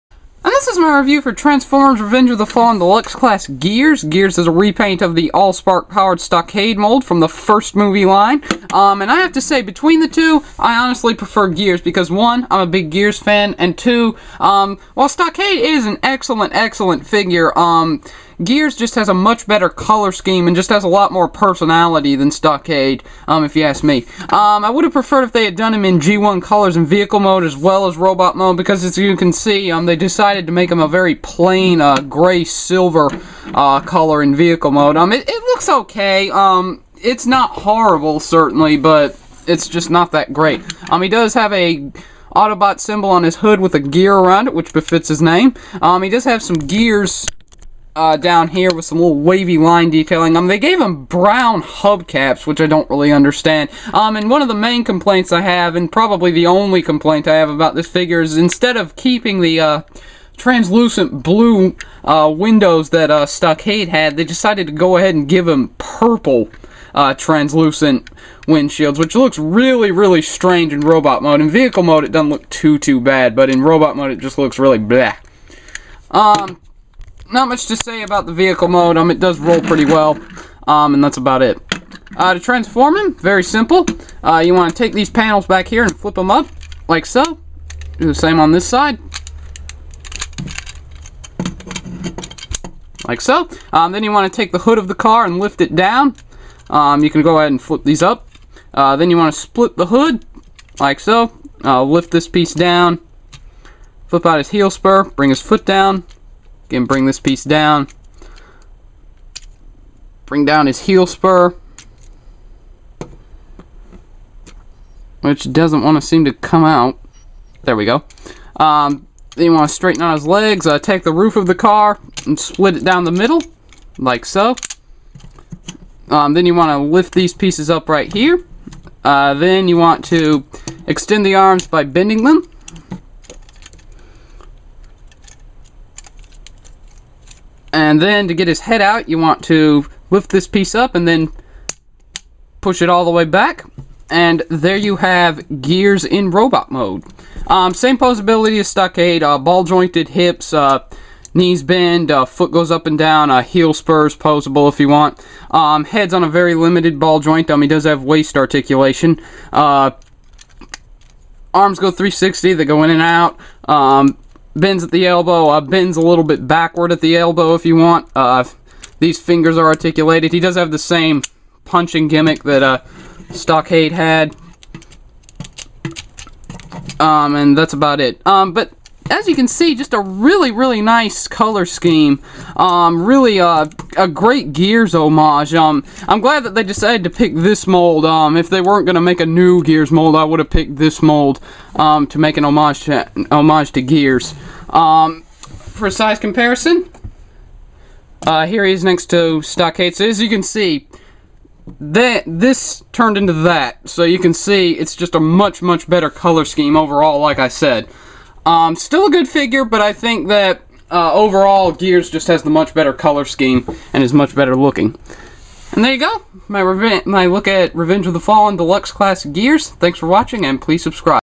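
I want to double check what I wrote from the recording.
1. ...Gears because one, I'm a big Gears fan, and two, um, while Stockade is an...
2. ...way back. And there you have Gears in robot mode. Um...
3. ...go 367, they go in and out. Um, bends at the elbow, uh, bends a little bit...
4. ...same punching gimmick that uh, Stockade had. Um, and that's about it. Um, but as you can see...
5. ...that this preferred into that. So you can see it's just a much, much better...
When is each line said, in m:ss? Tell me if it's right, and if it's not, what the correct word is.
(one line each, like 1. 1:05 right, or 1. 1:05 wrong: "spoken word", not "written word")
1. 0:11 right
2. 2:23 right
3. 2:41 wrong: "360", not "367"
4. 2:50 right
5. 3:21 wrong: "turned", not "preferred".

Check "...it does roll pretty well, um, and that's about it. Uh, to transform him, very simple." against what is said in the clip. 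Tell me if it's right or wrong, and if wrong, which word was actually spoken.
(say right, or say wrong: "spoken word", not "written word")
right.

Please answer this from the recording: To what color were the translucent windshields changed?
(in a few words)
Purple.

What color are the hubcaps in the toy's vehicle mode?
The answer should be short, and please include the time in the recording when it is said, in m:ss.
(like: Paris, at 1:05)
Brown, at 0:51.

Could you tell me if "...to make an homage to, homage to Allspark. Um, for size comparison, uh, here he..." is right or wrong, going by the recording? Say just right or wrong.
wrong.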